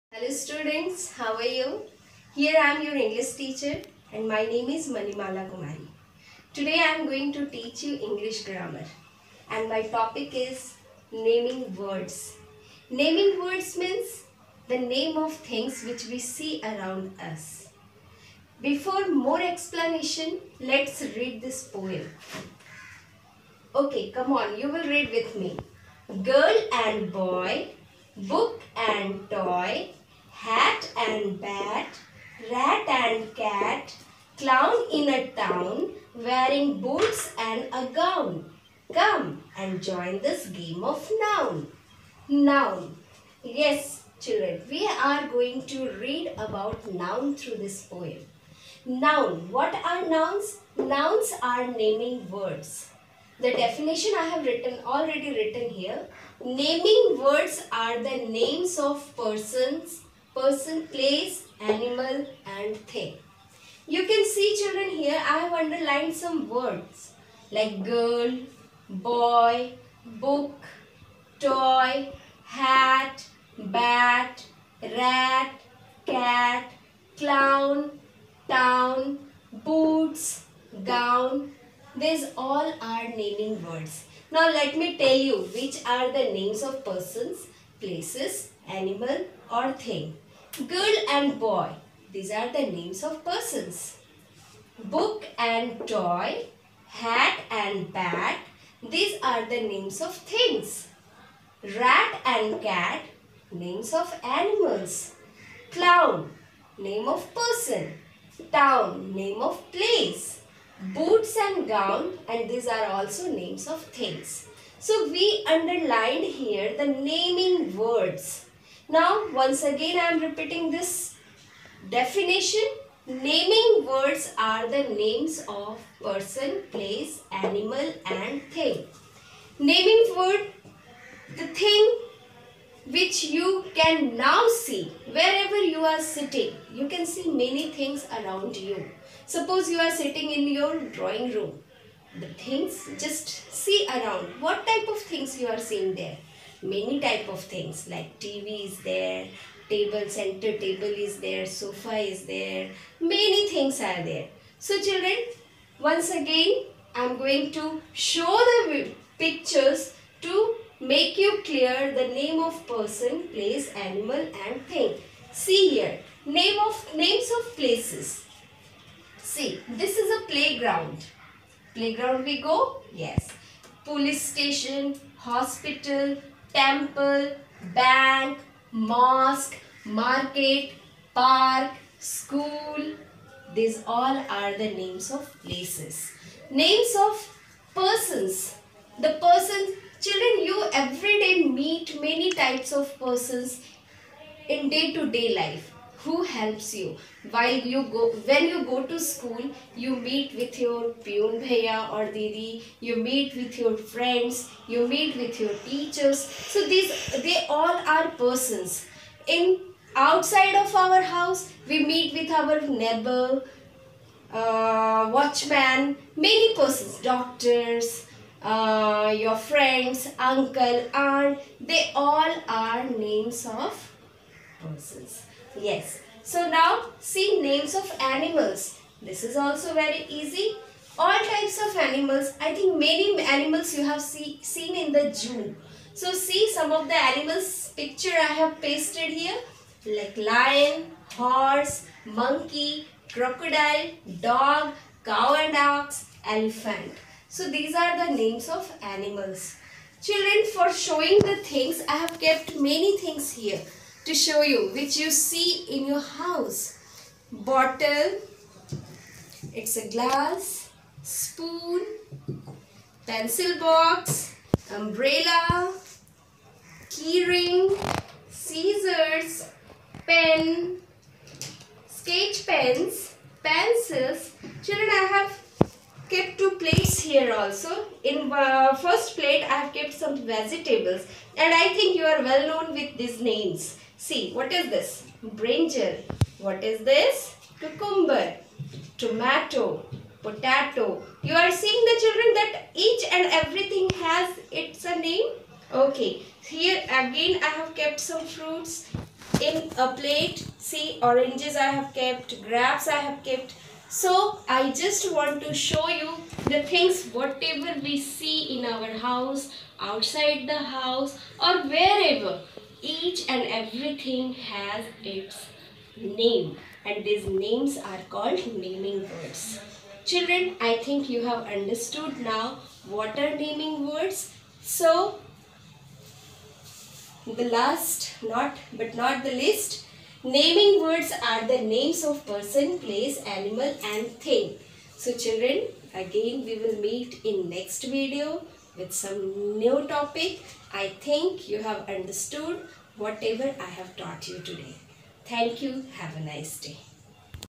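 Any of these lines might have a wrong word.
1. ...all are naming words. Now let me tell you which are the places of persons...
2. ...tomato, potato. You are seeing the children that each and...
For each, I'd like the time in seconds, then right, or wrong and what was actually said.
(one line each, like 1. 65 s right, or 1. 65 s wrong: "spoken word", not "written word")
1. 82 s wrong: "names", not "places"
2. 288 s right.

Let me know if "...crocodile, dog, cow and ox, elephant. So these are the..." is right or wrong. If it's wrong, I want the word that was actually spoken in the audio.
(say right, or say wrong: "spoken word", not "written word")
right.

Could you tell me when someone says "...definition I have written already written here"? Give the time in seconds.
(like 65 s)
53 s.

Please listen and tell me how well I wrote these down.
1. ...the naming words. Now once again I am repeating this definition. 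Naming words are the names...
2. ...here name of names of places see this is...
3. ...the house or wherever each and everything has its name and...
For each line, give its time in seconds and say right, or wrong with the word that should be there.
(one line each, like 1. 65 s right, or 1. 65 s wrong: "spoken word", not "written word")
1. 116 s right
2. 165 s right
3. 310 s right.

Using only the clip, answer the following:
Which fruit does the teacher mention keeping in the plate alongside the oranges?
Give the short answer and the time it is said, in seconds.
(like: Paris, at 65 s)
grapes, at 302 s.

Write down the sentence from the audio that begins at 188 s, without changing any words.
The persons, children, you every day meet many types of persons in day-to-day -day life who helps you.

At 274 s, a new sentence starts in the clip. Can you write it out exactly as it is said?
Children, I have kept two plates here also.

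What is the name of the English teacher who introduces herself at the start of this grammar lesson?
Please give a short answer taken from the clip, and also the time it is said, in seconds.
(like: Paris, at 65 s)
Manimala Kumari, at 4 s.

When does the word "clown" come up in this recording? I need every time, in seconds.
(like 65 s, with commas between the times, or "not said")
34 s, 77 s, 105 s.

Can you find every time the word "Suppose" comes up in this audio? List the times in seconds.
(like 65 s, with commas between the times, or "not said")
139 s.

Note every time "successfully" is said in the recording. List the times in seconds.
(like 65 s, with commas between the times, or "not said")
not said.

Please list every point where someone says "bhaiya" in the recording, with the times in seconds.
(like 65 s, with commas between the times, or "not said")
201 s.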